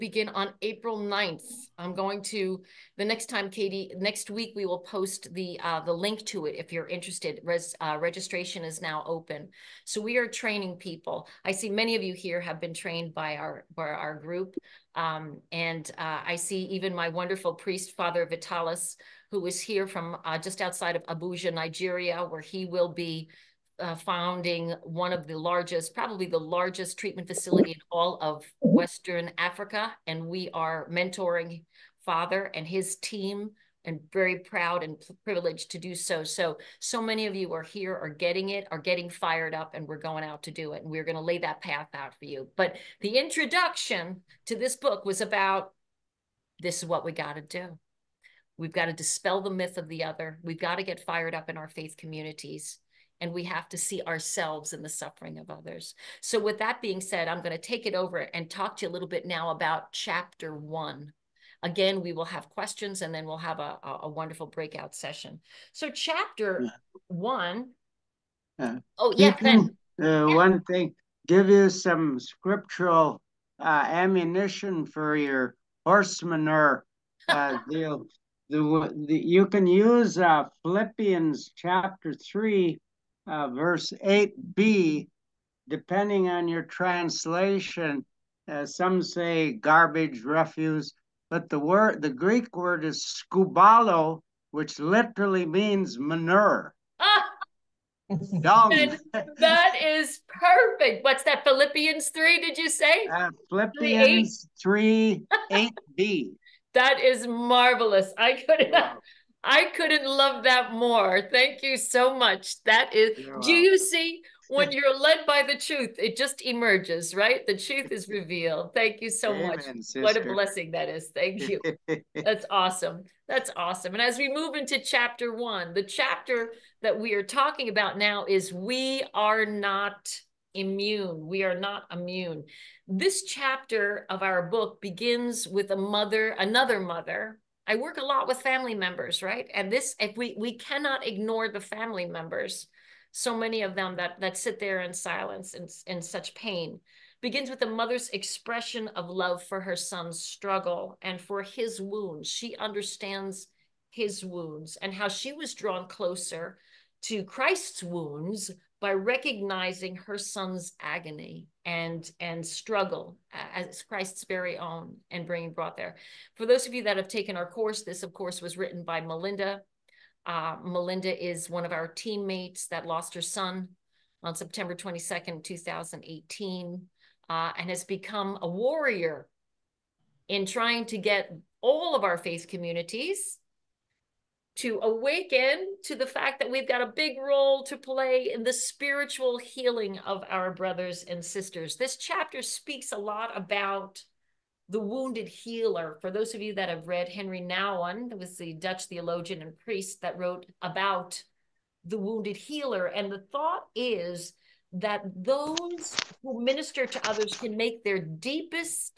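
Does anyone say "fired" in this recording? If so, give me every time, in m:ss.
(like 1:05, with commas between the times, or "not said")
0:39, 0:51.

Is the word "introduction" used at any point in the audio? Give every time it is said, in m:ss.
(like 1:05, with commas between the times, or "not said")
0:43.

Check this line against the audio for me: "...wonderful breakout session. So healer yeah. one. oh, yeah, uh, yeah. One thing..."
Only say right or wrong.
wrong.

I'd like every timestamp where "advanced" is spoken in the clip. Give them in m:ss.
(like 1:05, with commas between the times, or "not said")
not said.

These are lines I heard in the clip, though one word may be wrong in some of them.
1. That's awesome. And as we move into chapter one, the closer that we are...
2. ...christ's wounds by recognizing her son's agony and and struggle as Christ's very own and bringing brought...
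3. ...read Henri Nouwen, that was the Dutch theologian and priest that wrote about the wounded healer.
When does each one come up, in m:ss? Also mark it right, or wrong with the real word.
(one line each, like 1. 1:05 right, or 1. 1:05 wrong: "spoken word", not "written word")
1. 2:03 wrong: "chapter", not "closer"
2. 2:37 right
3. 3:16 right.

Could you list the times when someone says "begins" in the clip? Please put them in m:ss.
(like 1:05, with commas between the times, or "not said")
2:14, 2:27.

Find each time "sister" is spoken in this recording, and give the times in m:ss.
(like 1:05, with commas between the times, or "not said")
1:59, 3:11.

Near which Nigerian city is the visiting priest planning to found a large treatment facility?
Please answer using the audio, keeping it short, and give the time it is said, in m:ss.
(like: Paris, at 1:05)
Abuja, at 0:21.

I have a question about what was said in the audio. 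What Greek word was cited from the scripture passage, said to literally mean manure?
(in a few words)
skubalo.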